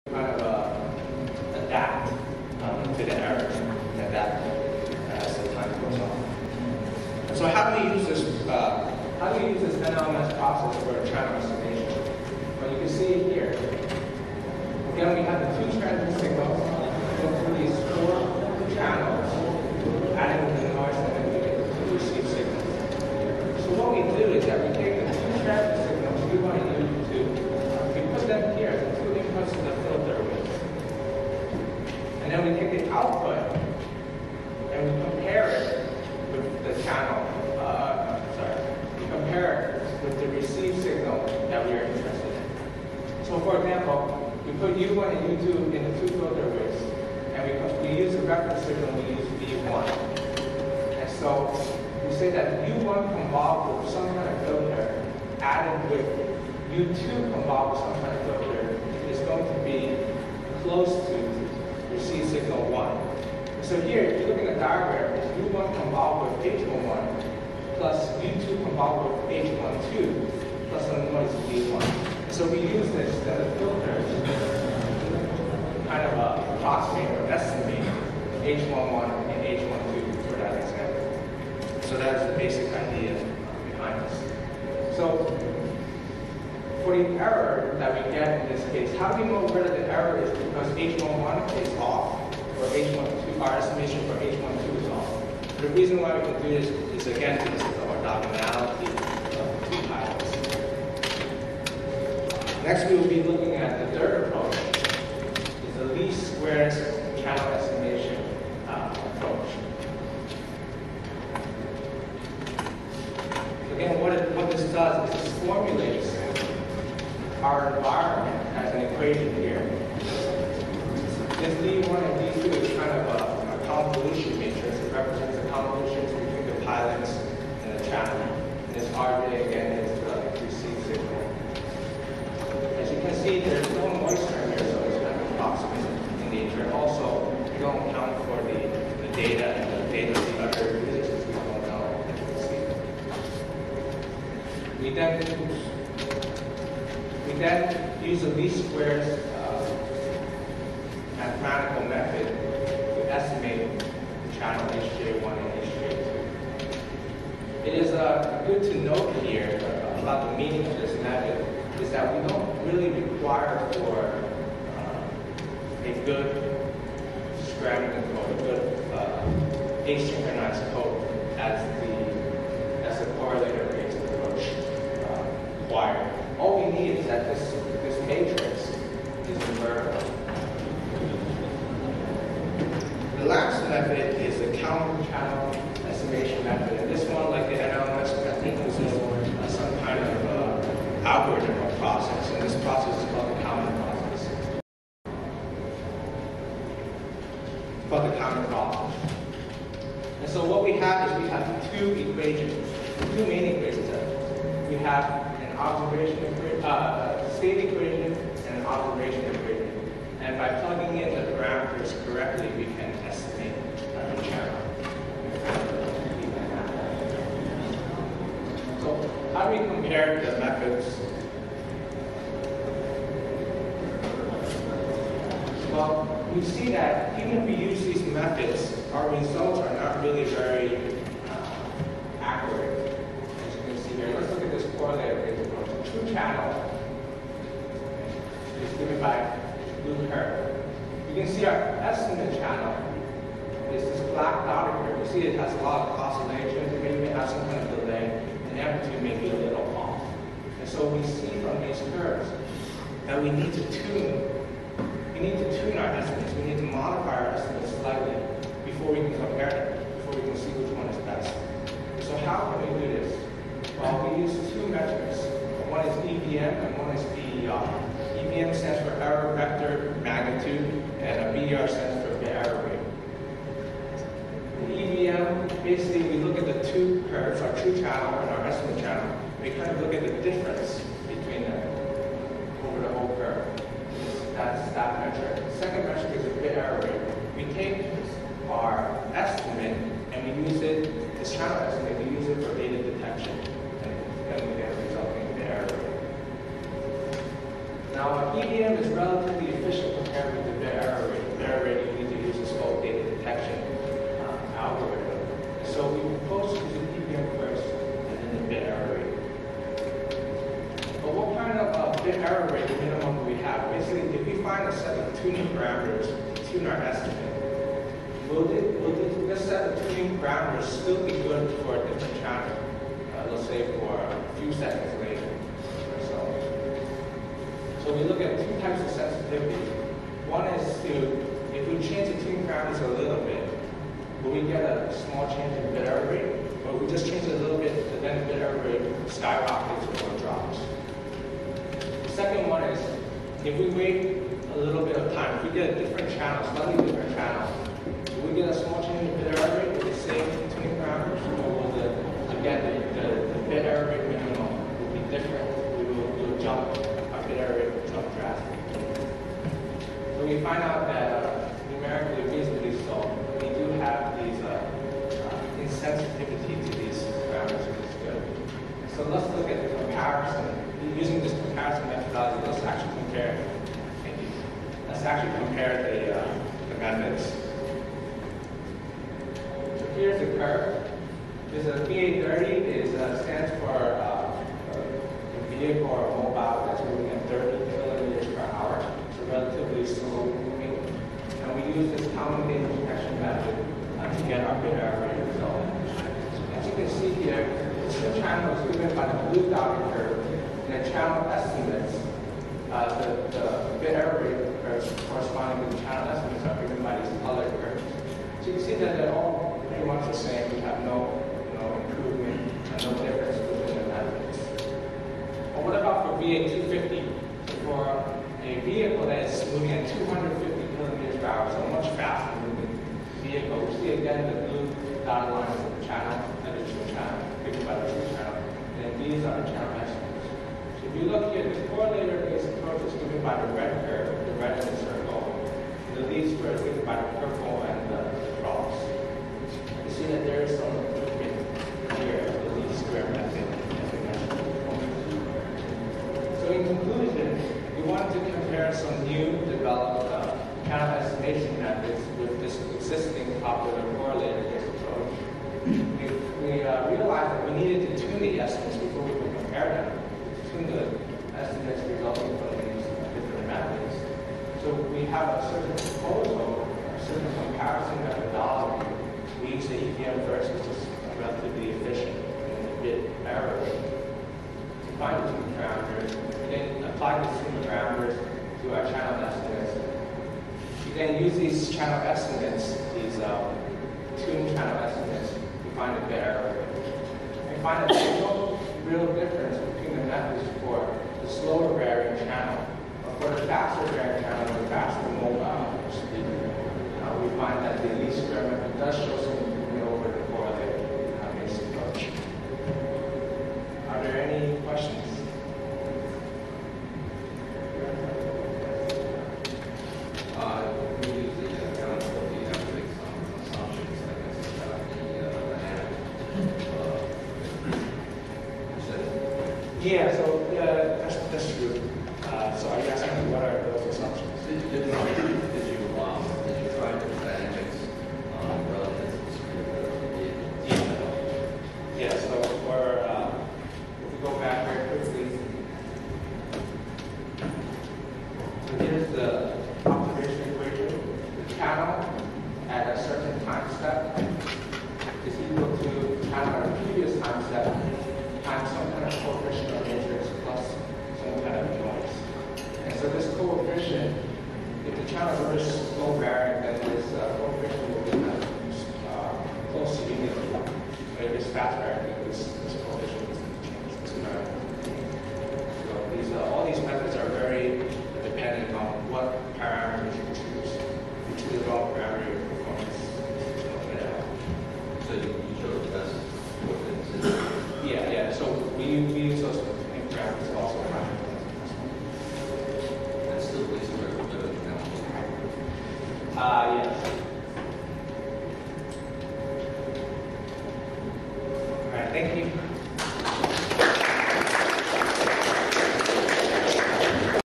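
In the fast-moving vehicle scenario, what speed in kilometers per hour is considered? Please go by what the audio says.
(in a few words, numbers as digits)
250.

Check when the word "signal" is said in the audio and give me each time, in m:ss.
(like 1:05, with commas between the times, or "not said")
0:16, 0:48, 1:02.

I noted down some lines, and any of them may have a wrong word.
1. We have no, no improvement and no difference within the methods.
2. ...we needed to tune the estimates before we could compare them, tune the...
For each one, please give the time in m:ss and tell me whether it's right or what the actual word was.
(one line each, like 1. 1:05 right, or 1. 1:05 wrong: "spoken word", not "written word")
1. 6:50 right
2. 7:37 right.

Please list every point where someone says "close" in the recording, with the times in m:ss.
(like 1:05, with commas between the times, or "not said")
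1:00, 9:19.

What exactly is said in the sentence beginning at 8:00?
You then use these channel estimates, these uh, tuned channel estimates, to find a bit error.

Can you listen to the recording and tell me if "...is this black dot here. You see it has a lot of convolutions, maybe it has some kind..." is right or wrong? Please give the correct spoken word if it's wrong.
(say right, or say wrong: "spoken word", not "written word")
wrong: "oscillations", not "convolutions".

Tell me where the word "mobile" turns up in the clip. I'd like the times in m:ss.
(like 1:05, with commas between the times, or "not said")
6:26, 8:15.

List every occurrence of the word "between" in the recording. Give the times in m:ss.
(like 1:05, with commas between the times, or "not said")
2:06, 8:09.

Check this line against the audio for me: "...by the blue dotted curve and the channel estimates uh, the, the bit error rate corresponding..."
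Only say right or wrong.
right.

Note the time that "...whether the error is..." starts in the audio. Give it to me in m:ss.
1:29.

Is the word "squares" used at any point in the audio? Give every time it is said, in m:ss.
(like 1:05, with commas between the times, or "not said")
1:46, 2:28, 7:16, 7:22.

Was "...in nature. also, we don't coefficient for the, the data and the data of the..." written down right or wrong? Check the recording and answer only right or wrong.
wrong.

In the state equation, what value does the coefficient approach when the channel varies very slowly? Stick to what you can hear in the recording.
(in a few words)
Unity.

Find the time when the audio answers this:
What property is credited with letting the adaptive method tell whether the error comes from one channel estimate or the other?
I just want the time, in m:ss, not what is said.
1:38.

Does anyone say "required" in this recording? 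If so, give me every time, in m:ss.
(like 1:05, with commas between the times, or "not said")
2:42, 2:55.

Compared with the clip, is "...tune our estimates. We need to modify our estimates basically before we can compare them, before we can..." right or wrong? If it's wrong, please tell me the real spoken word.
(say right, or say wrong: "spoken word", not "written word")
wrong: "slightly", not "basically".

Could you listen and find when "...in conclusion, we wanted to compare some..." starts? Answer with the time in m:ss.
7:26.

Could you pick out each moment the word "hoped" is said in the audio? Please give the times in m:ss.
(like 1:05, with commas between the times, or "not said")
not said.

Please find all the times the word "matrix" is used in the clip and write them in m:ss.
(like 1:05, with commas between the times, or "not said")
2:04, 9:09.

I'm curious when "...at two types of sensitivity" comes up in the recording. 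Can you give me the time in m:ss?
5:28.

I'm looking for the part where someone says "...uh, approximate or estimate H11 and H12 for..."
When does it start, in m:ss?
1:16.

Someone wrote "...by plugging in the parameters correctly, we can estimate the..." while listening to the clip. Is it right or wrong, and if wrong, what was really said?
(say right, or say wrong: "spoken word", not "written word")
right.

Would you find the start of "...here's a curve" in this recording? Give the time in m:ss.
6:19.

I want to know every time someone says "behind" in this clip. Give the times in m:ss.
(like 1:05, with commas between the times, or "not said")
1:23.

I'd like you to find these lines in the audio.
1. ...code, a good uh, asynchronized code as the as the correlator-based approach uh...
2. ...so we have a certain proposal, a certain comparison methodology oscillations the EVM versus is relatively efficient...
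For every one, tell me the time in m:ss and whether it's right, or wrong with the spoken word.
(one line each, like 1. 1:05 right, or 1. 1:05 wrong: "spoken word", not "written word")
1. 2:48 right
2. 7:44 wrong: "means", not "oscillations".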